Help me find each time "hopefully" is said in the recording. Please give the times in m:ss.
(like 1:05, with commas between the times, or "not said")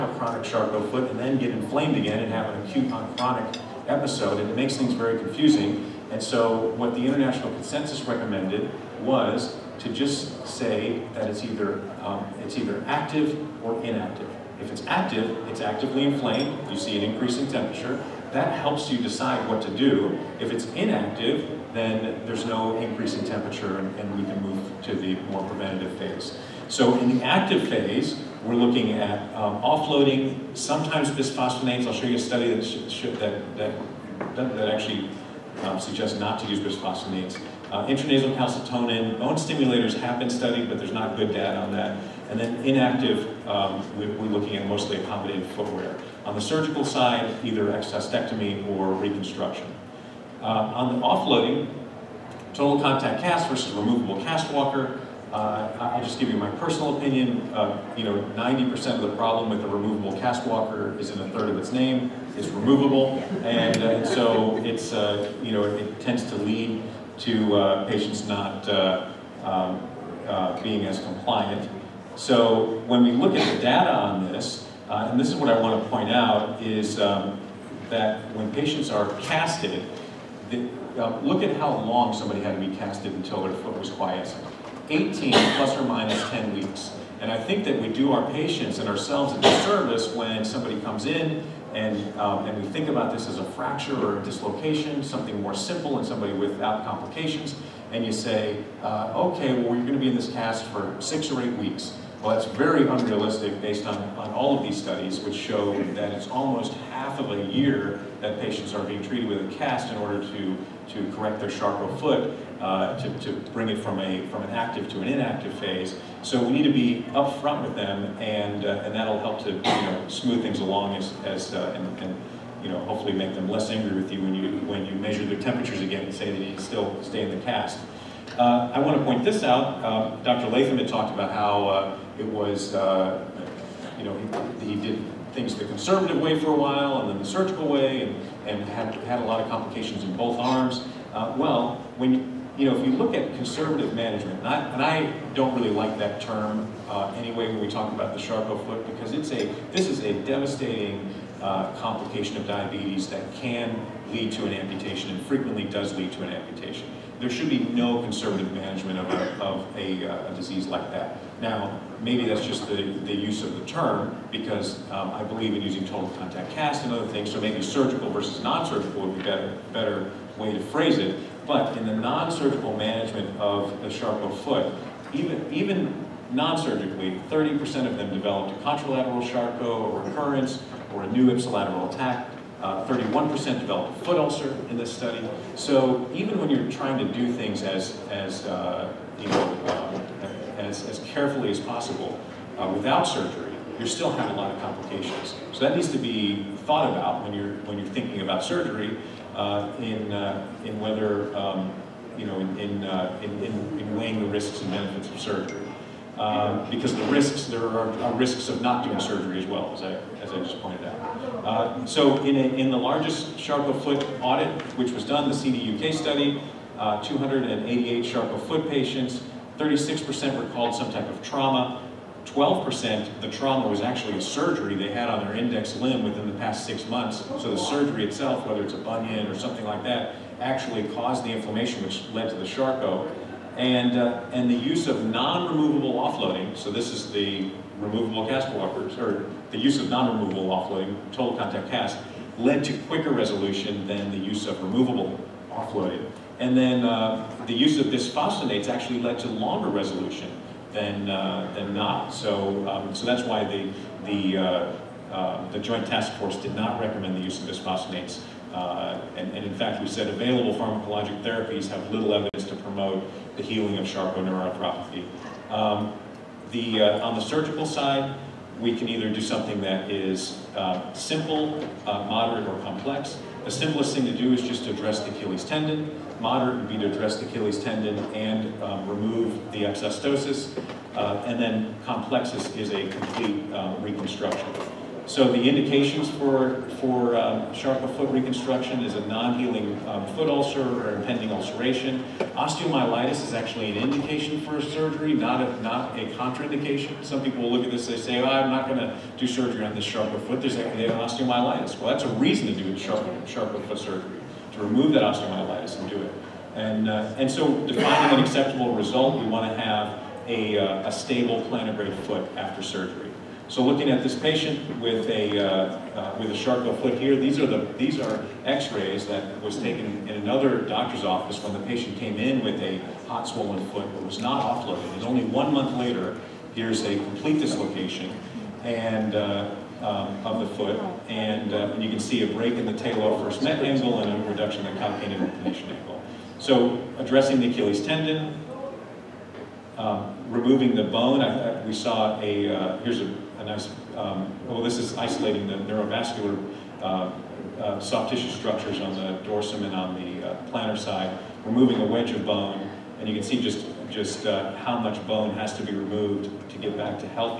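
2:02.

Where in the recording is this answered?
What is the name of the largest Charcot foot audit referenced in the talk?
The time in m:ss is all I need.
3:35.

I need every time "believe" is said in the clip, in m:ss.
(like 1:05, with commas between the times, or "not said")
2:45.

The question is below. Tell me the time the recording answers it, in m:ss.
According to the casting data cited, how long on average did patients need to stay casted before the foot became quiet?
1:24.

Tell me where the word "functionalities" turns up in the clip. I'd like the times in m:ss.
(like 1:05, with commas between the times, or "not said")
not said.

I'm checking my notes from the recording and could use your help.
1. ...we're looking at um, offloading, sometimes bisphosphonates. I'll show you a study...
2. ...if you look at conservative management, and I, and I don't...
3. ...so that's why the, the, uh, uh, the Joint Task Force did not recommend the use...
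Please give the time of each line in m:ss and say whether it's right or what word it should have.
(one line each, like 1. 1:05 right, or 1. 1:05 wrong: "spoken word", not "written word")
1. 0:28 right
2. 2:22 right
3. 4:12 right.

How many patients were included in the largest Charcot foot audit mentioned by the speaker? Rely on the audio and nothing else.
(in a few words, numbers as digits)
288.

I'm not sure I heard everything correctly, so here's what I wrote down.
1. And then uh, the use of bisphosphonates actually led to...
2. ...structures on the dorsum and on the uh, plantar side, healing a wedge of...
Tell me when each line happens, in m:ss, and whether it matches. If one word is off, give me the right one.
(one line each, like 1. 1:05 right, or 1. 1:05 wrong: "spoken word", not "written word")
1. 4:06 right
2. 5:48 wrong: "removing", not "healing".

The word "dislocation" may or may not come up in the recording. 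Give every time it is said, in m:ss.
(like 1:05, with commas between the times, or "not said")
1:34, 5:27.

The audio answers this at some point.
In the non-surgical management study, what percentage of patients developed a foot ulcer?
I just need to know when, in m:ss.
3:02.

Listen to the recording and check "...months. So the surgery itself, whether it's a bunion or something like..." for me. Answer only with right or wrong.
right.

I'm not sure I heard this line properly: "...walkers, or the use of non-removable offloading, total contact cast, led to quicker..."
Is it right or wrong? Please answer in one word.
right.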